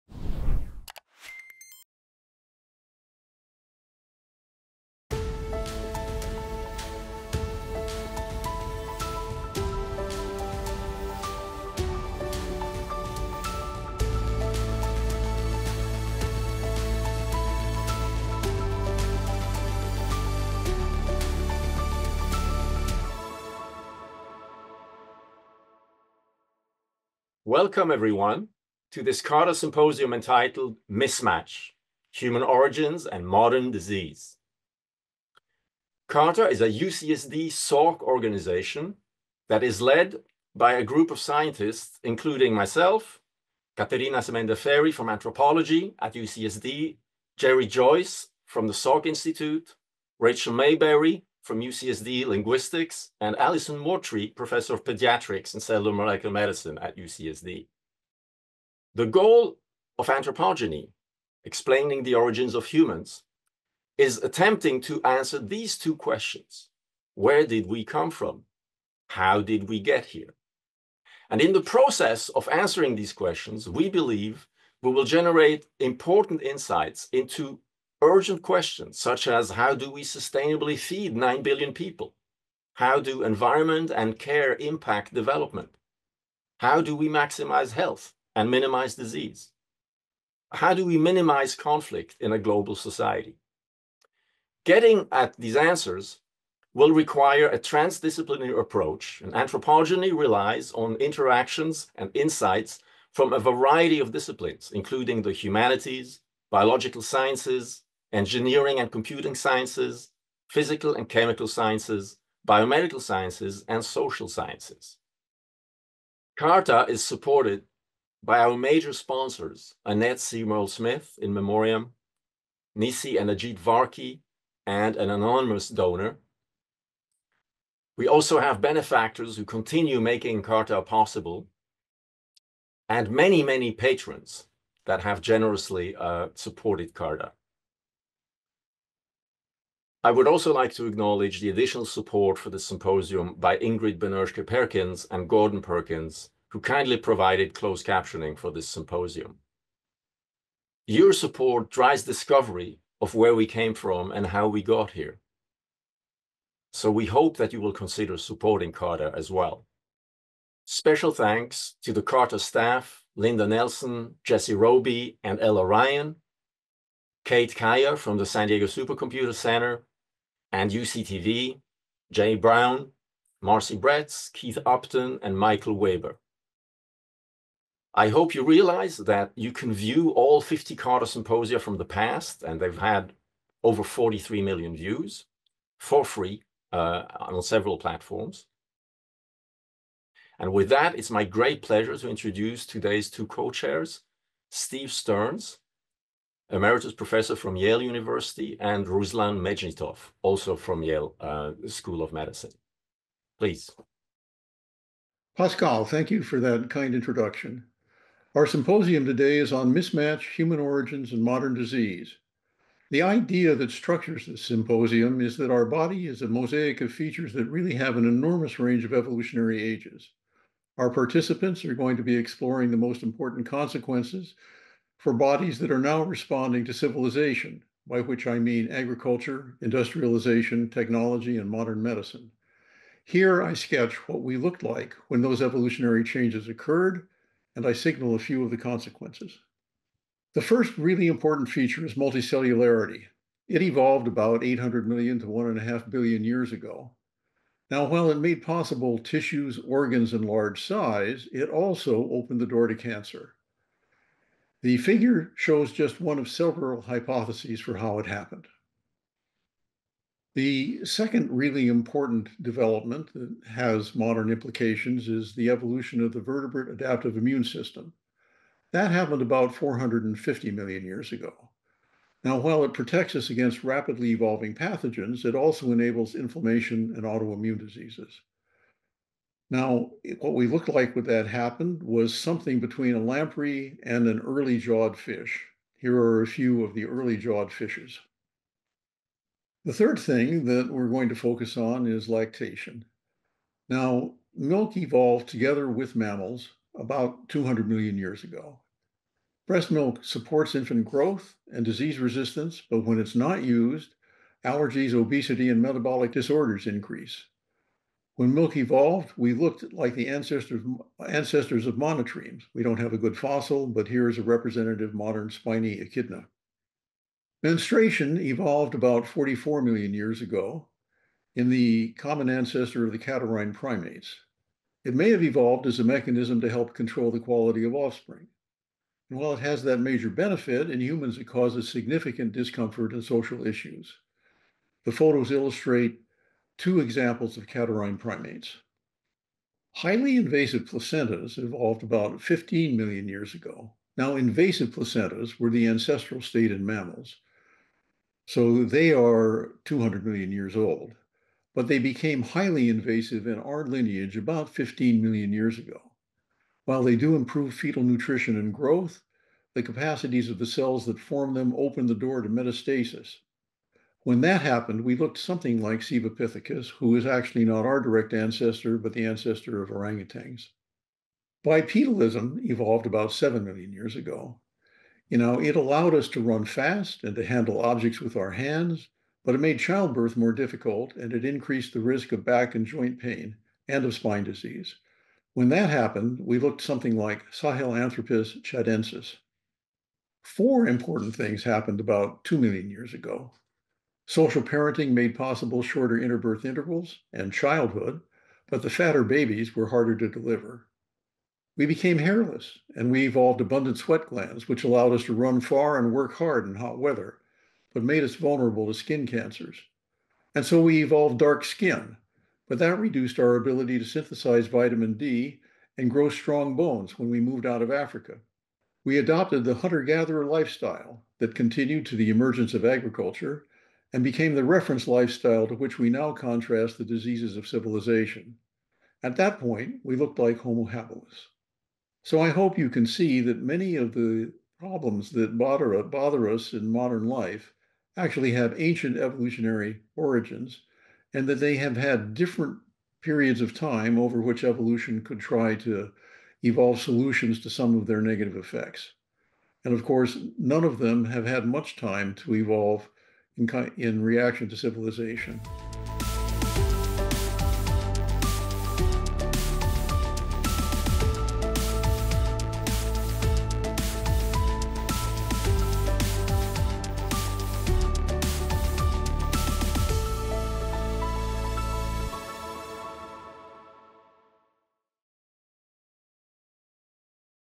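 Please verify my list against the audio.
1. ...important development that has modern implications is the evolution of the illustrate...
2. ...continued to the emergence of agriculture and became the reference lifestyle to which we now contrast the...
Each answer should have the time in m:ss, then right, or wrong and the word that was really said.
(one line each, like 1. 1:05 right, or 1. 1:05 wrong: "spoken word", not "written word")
1. 4:21 wrong: "vertebrate", not "illustrate"
2. 7:01 right.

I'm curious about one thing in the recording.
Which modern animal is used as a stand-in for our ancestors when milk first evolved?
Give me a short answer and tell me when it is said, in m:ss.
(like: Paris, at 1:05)
spiny echidna, at 5:15.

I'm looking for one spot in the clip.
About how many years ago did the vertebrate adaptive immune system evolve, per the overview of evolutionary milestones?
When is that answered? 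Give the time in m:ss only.
4:29.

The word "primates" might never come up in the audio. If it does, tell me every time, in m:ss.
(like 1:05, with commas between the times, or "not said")
5:23, 5:37.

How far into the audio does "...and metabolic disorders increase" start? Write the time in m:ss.
5:05.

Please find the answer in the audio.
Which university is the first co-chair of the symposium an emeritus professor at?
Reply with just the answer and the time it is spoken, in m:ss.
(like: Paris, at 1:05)
Yale University, at 3:17.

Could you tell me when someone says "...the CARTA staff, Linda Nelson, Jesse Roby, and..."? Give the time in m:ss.
2:41.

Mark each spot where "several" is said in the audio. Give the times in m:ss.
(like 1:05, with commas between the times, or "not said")
3:07, 4:16.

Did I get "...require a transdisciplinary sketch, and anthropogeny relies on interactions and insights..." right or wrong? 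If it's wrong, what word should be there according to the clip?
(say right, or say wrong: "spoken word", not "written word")
wrong: "approach", not "sketch".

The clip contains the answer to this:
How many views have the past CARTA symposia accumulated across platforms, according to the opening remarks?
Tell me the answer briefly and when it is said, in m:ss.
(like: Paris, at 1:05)
43 million, at 3:03.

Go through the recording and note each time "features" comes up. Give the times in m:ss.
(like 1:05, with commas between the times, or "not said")
3:36, 4:01.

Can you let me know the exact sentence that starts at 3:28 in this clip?
Our symposium today is on mismatch, human origins, and modern disease.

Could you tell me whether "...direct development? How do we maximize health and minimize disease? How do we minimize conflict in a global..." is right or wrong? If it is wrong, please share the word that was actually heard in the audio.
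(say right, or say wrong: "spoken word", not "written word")
wrong: "impact", not "direct".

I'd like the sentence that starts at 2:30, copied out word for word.
Your support drives discovery of where we came from and how we got here.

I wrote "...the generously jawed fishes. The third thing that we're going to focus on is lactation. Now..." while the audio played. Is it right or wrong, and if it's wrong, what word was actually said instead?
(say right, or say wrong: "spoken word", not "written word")
wrong: "early", not "generously".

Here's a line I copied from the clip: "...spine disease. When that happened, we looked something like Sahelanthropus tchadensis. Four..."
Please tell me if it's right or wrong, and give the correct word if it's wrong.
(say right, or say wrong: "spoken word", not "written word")
right.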